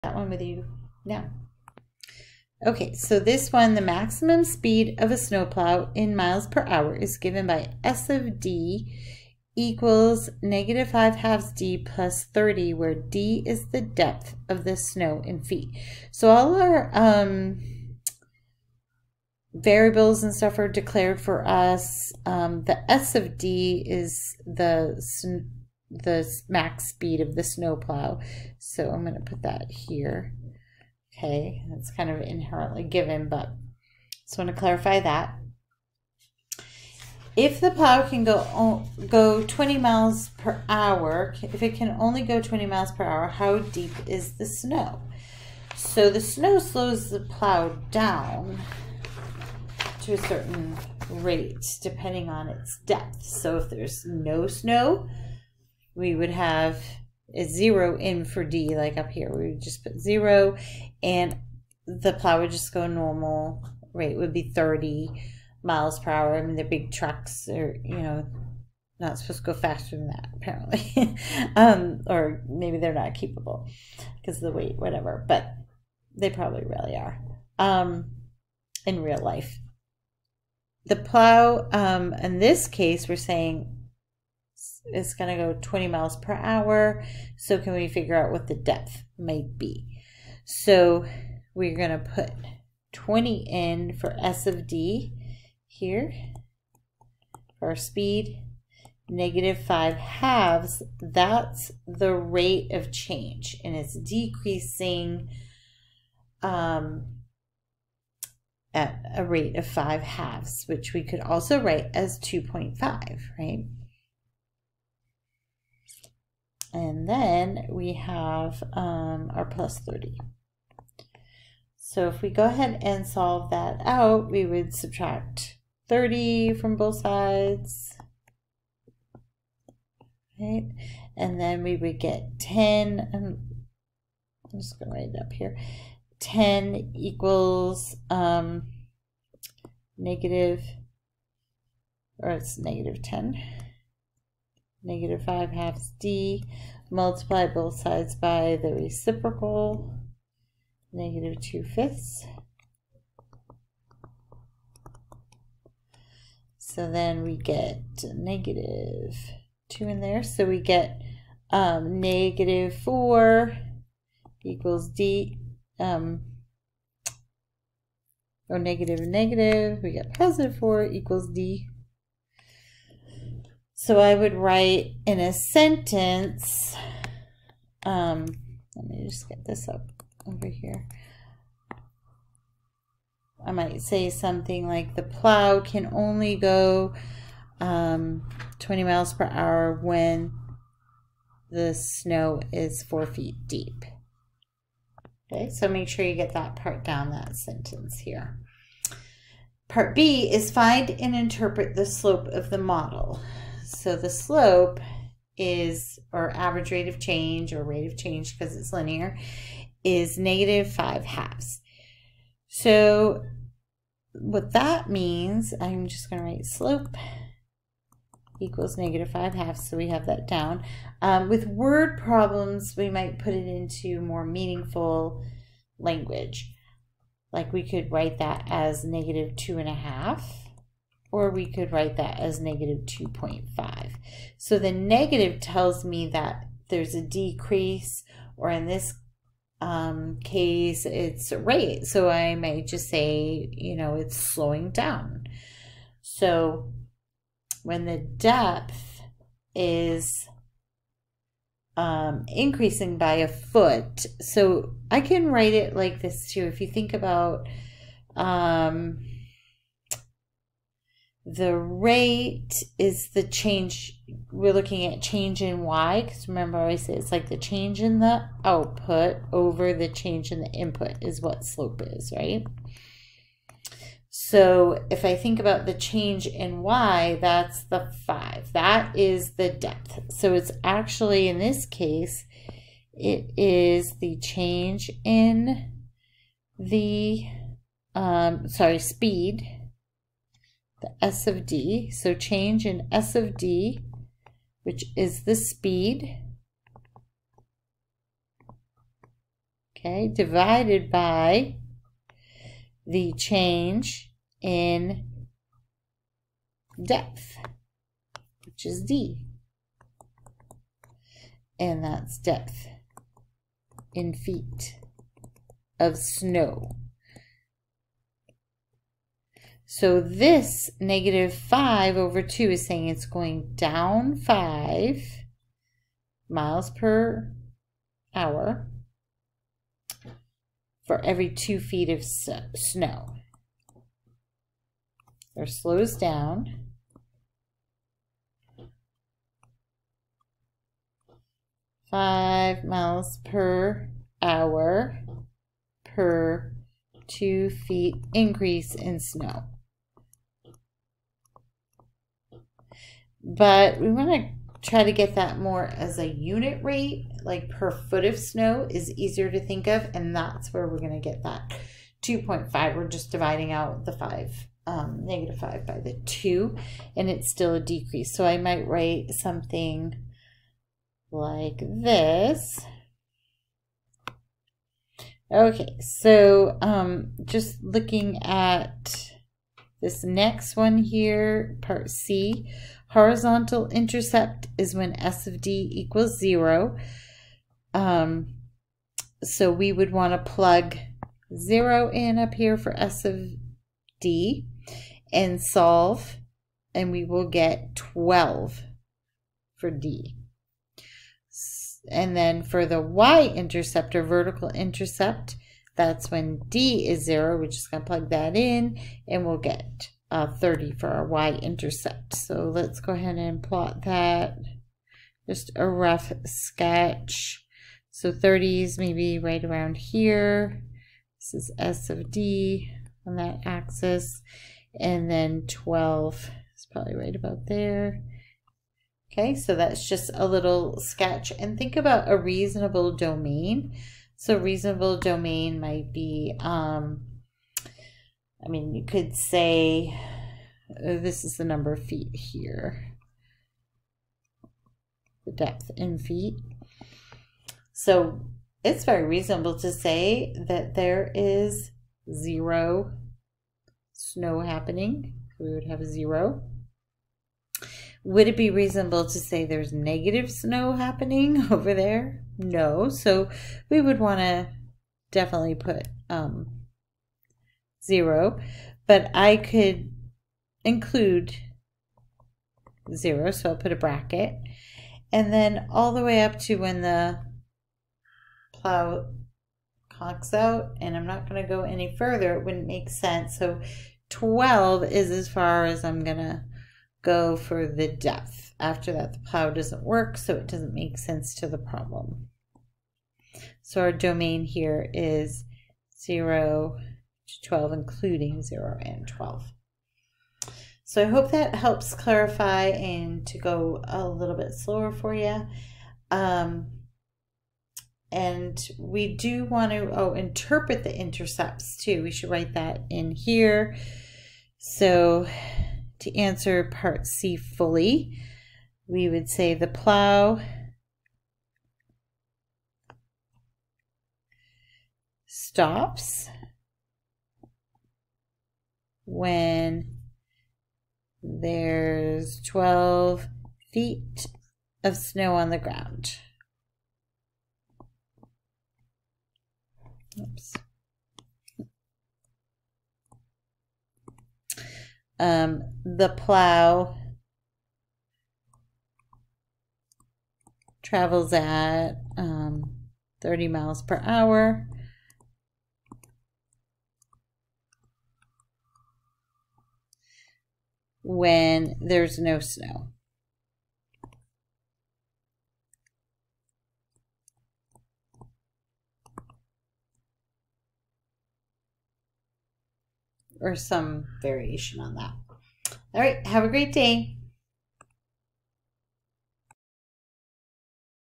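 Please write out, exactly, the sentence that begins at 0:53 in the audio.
So if there's no snow, we would have a zero in for D, like up here.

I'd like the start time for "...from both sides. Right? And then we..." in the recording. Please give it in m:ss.
2:06.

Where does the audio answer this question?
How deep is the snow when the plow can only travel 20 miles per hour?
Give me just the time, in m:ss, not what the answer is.
3:12.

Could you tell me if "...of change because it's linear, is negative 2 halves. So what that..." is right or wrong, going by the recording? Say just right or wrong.
wrong.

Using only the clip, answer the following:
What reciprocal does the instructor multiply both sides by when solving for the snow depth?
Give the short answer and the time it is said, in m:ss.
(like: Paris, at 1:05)
negative 2 fifths, at 2:30.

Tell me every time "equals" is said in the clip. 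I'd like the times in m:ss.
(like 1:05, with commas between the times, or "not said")
0:09, 2:16, 2:44, 2:50, 3:38, 6:25.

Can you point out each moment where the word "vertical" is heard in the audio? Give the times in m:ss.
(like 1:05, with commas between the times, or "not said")
6:44.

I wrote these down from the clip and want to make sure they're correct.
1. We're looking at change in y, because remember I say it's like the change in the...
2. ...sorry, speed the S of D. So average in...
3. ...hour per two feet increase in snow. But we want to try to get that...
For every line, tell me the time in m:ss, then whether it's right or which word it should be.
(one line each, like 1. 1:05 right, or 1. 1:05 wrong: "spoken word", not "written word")
1. 4:24 right
2. 4:48 wrong: "change", not "average"
3. 5:44 right.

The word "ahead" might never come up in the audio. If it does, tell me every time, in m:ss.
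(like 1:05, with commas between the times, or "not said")
2:02, 6:52.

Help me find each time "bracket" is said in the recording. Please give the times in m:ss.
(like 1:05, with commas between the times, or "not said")
7:53.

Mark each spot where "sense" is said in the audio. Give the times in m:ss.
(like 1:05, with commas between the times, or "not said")
8:02, 8:10.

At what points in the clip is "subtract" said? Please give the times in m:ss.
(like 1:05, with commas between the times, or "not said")
2:04.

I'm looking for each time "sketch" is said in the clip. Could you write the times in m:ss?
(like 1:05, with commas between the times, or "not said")
6:56, 7:10.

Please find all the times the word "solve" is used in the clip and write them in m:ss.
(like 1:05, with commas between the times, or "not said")
2:03, 6:35.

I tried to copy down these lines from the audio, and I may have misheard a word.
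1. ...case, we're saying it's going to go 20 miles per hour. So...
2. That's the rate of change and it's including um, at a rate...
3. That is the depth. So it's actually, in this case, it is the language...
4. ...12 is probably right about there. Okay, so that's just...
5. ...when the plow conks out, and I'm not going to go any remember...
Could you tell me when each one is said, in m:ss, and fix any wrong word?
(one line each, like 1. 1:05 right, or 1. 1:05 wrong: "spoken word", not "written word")
1. 1:22 right
2. 1:40 wrong: "decreasing", not "including"
3. 4:38 wrong: "change", not "language"
4. 7:05 right
5. 7:56 wrong: "further", not "remember".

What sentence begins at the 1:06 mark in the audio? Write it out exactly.
I mean, the big trucks are, you know, not supposed to go faster than that, apparently.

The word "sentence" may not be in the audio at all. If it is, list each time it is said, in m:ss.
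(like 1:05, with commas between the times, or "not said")
2:55, 3:17.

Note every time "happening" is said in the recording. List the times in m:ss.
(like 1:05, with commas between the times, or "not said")
7:34, 7:40.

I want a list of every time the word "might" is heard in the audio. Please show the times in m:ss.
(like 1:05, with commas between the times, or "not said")
1:29, 3:03, 3:42, 4:02, 6:08, 7:15.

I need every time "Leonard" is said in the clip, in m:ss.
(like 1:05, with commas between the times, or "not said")
not said.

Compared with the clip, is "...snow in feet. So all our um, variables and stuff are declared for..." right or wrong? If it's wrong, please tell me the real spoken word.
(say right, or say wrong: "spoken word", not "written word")
right.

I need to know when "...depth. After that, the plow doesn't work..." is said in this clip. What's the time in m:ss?
8:07.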